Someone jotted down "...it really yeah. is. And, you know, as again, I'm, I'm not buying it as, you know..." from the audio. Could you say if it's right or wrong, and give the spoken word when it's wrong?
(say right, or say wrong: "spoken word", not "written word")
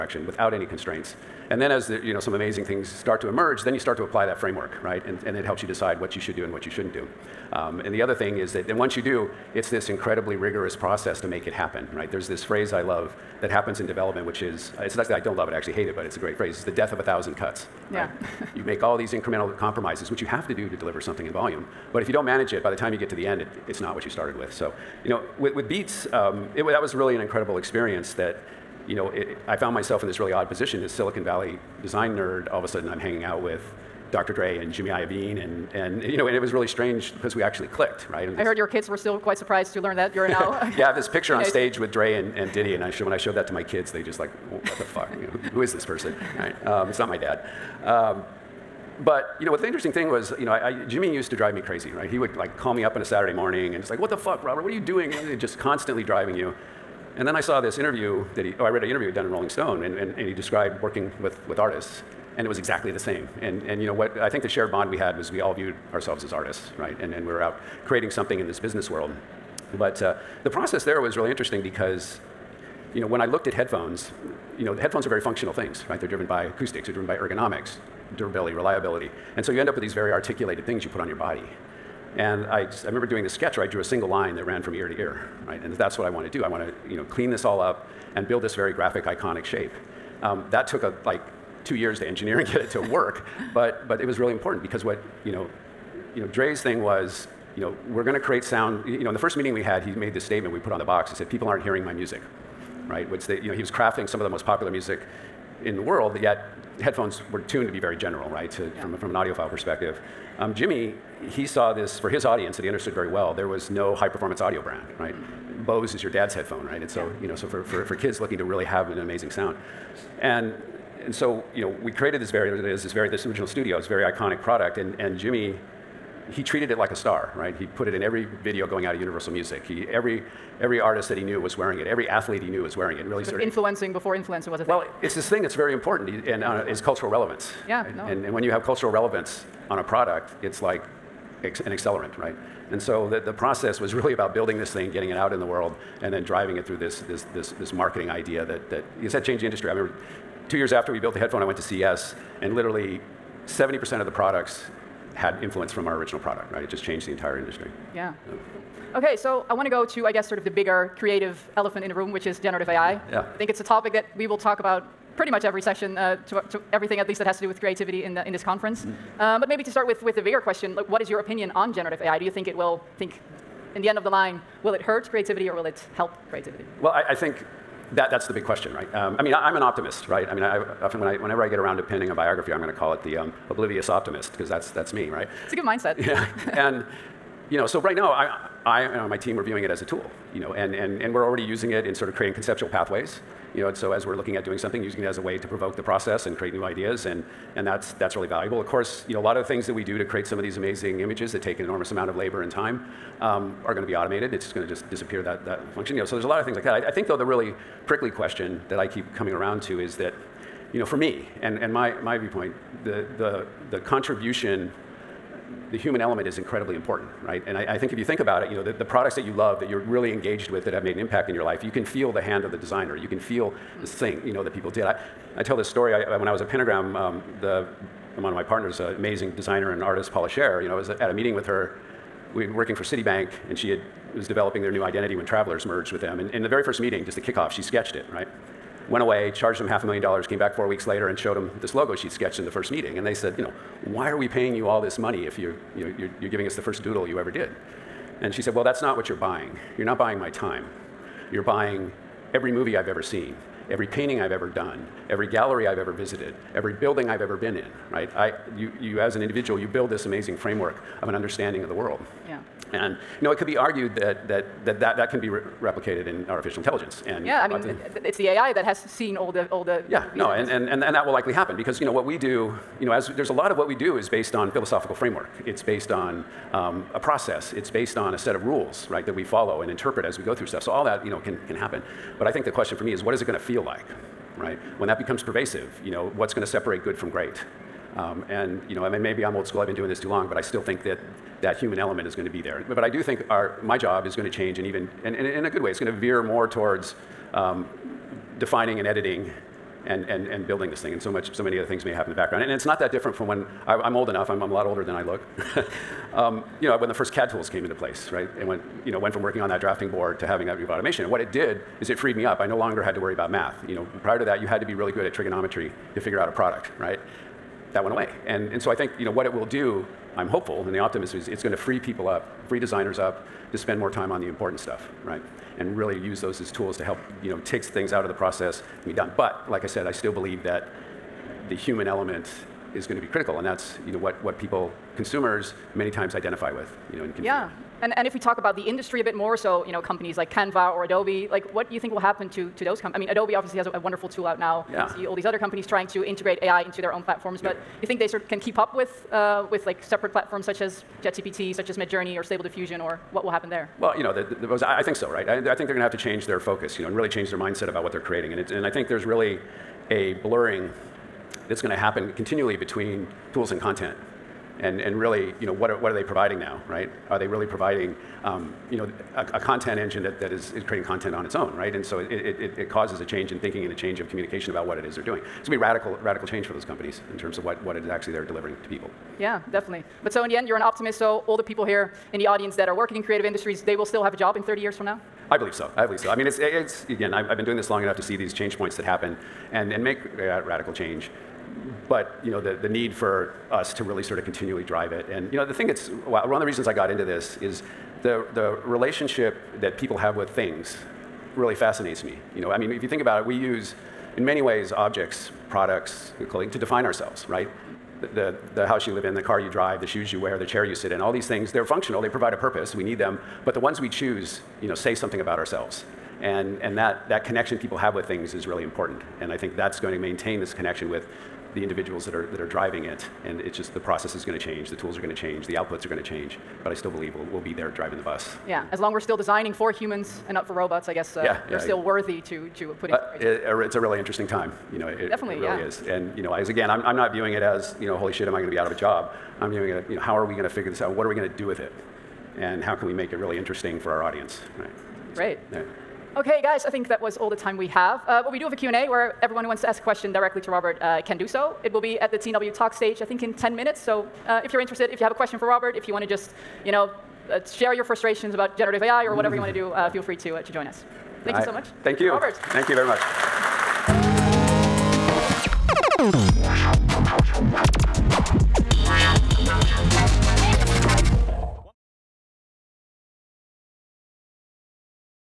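wrong: "viewing", not "buying".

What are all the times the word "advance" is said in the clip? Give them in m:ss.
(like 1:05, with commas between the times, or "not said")
not said.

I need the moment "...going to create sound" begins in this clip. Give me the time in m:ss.
1:38.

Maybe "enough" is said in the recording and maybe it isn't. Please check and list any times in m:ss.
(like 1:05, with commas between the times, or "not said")
5:04, 6:27.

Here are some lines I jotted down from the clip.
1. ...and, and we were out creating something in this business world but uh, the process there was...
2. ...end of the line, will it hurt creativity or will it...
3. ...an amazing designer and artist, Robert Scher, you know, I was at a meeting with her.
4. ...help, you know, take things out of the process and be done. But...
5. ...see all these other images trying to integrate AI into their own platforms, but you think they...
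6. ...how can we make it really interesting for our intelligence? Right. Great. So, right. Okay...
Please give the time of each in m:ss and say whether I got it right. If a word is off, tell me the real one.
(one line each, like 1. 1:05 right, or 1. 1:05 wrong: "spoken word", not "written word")
1. 1:06 right
2. 2:53 right
3. 3:48 wrong: "Paula", not "Robert"
4. 5:26 right
5. 5:45 wrong: "companies", not "images"
6. 7:22 wrong: "audience", not "intelligence".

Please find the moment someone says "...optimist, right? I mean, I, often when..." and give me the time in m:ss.
2:59.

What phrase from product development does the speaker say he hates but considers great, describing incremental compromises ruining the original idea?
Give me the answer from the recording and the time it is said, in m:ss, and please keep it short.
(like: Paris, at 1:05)
death of a thousand cuts, at 0:16.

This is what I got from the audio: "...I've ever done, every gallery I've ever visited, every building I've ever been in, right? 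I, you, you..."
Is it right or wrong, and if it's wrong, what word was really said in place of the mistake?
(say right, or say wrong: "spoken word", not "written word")
right.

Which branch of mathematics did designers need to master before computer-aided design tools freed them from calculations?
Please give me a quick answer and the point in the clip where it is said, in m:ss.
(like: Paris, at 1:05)
trigonometry, at 5:15.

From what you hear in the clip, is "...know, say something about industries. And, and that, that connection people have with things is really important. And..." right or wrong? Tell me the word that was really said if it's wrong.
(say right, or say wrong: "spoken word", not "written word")
wrong: "ourselves", not "industries".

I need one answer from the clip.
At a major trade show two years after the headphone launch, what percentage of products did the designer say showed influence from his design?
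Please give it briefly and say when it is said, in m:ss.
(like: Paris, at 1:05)
70%, at 2:33.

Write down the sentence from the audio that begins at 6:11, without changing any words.
And so it, it, it, causes a change in thinking and a change of communication about what it is they're doing.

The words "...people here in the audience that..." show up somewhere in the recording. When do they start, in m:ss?
6:21.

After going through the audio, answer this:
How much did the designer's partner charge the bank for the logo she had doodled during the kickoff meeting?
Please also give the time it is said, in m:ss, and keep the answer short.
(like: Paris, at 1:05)
half a million dollars, at 3:59.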